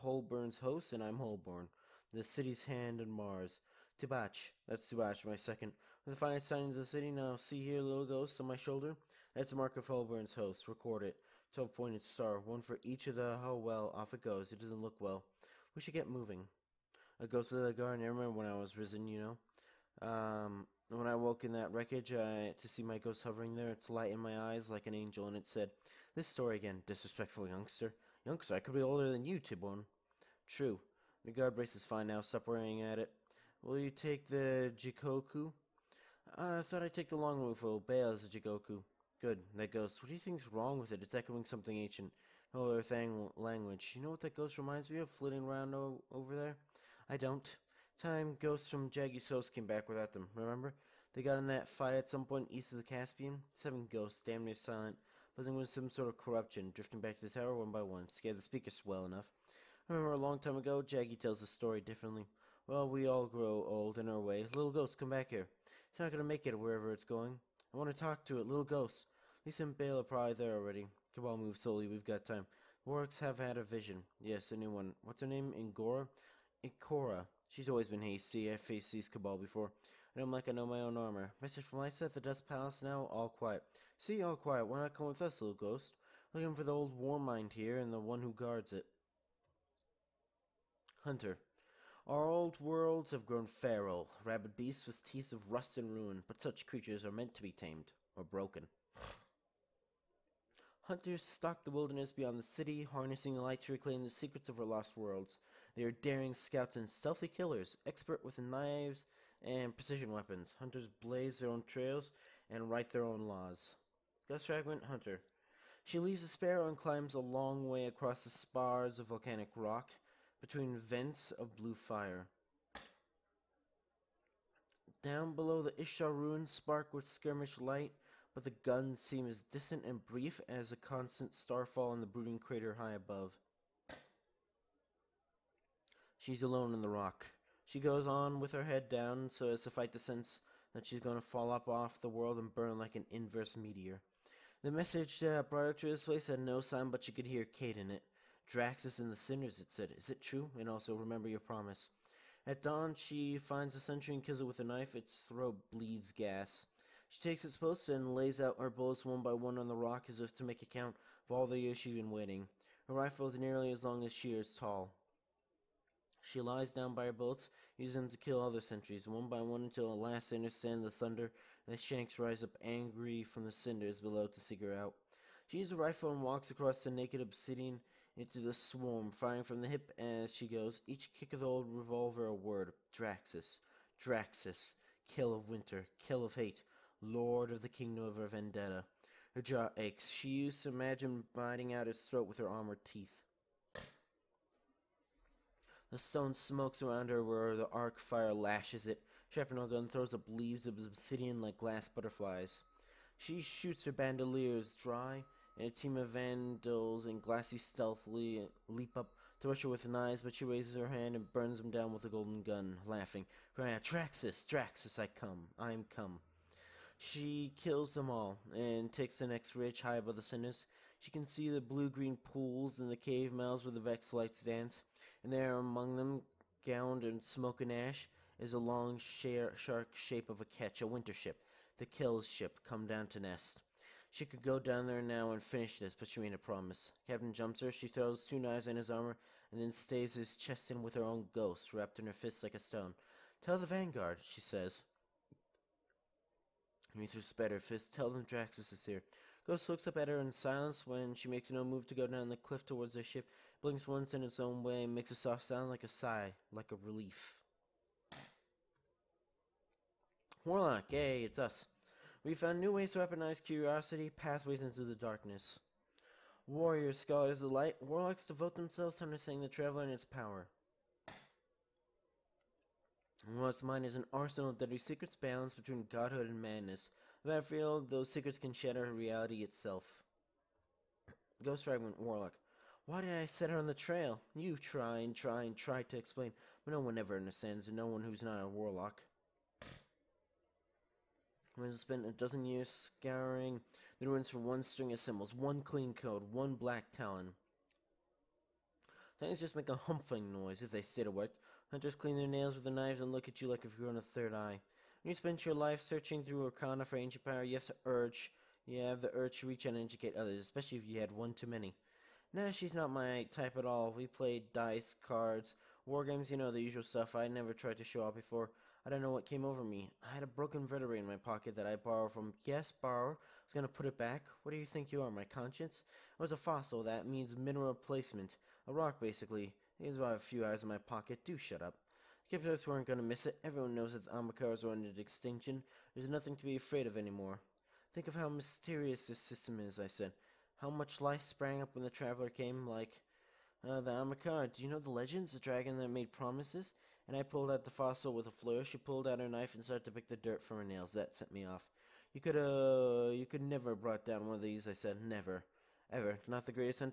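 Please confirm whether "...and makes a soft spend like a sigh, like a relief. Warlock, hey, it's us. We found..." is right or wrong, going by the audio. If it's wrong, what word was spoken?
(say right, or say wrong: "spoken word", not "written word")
wrong: "sound", not "spend".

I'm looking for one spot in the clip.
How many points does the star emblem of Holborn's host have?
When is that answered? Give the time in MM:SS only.
00:11.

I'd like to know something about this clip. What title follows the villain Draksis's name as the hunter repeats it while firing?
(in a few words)
Kell of Winter.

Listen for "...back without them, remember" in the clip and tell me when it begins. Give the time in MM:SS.
00:49.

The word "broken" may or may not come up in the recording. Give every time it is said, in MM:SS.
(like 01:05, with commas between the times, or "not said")
01:38, 05:20.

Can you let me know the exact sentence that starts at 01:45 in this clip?
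They are daring scouts and stealthy killers, expert with knives and precision weapons.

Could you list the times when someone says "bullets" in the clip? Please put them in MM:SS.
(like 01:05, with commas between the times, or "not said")
02:38, 02:47.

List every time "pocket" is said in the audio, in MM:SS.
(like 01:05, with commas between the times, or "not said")
05:21, 05:30.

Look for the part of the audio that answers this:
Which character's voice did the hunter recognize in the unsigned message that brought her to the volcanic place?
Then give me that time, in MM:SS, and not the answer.
02:27.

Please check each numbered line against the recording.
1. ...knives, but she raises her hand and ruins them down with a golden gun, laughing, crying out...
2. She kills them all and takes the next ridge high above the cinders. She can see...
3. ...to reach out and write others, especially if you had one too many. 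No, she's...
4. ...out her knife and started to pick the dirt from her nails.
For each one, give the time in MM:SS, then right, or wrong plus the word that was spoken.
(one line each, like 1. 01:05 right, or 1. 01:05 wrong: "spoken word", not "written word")
1. 03:29 wrong: "burns", not "ruins"
2. 03:36 right
3. 05:09 wrong: "educate", not "write"
4. 05:49 right.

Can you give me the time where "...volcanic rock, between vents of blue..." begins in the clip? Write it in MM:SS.
01:59.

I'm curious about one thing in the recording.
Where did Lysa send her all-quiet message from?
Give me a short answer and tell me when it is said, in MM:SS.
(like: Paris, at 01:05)
The Dust Palace, at 01:22.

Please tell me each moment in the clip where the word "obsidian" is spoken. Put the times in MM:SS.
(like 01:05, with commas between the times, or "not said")
02:57, 03:20.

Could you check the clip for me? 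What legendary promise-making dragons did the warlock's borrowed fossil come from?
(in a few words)
Ahamkara.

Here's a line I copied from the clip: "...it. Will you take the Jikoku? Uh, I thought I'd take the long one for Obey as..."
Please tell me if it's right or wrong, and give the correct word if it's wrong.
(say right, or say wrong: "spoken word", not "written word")
right.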